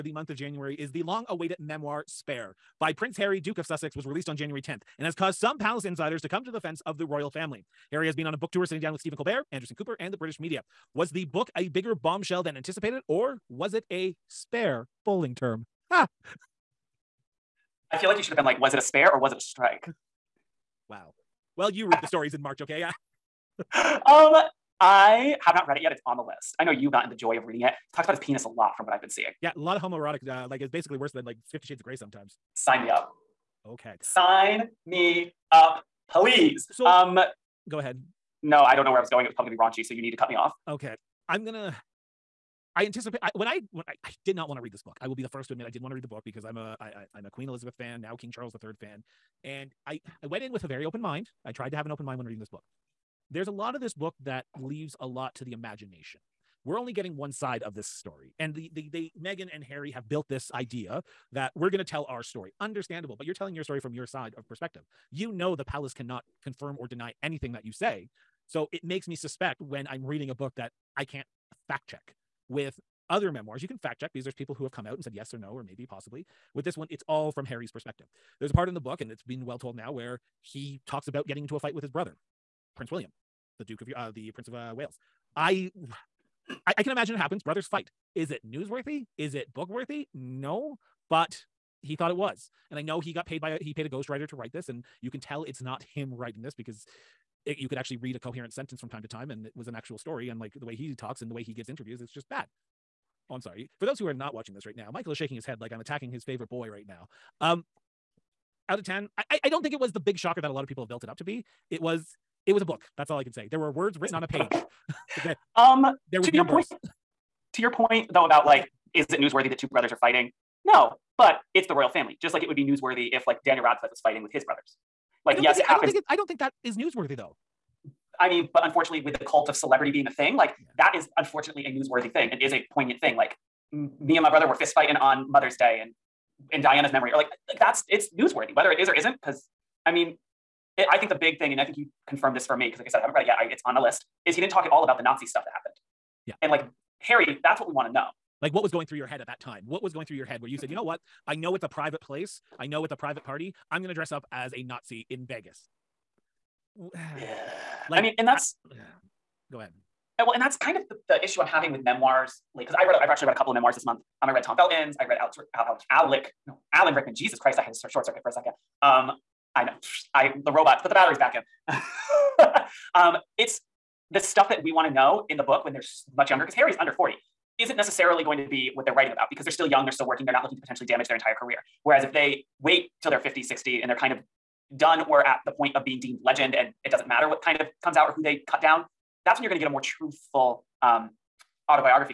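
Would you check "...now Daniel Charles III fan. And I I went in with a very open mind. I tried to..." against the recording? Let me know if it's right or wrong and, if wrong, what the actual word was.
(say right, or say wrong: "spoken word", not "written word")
wrong: "King", not "Daniel".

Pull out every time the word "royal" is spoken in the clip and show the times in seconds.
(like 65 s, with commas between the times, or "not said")
7 s, 121 s.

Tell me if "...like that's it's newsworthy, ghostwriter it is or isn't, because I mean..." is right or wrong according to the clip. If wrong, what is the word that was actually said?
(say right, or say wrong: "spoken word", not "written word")
wrong: "whether", not "ghostwriter".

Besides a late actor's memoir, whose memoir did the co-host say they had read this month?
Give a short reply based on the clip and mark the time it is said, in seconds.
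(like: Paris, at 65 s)
Tom Felton, at 164 s.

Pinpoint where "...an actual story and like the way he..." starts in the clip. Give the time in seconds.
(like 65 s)
99 s.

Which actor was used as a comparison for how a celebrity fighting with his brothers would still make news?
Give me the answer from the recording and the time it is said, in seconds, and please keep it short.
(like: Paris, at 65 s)
Daniel Radcliffe, at 123 s.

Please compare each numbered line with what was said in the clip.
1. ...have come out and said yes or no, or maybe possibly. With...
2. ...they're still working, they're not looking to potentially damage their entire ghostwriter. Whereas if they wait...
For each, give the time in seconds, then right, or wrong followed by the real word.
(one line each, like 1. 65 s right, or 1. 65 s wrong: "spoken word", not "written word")
1. 74 s right
2. 179 s wrong: "career", not "ghostwriter".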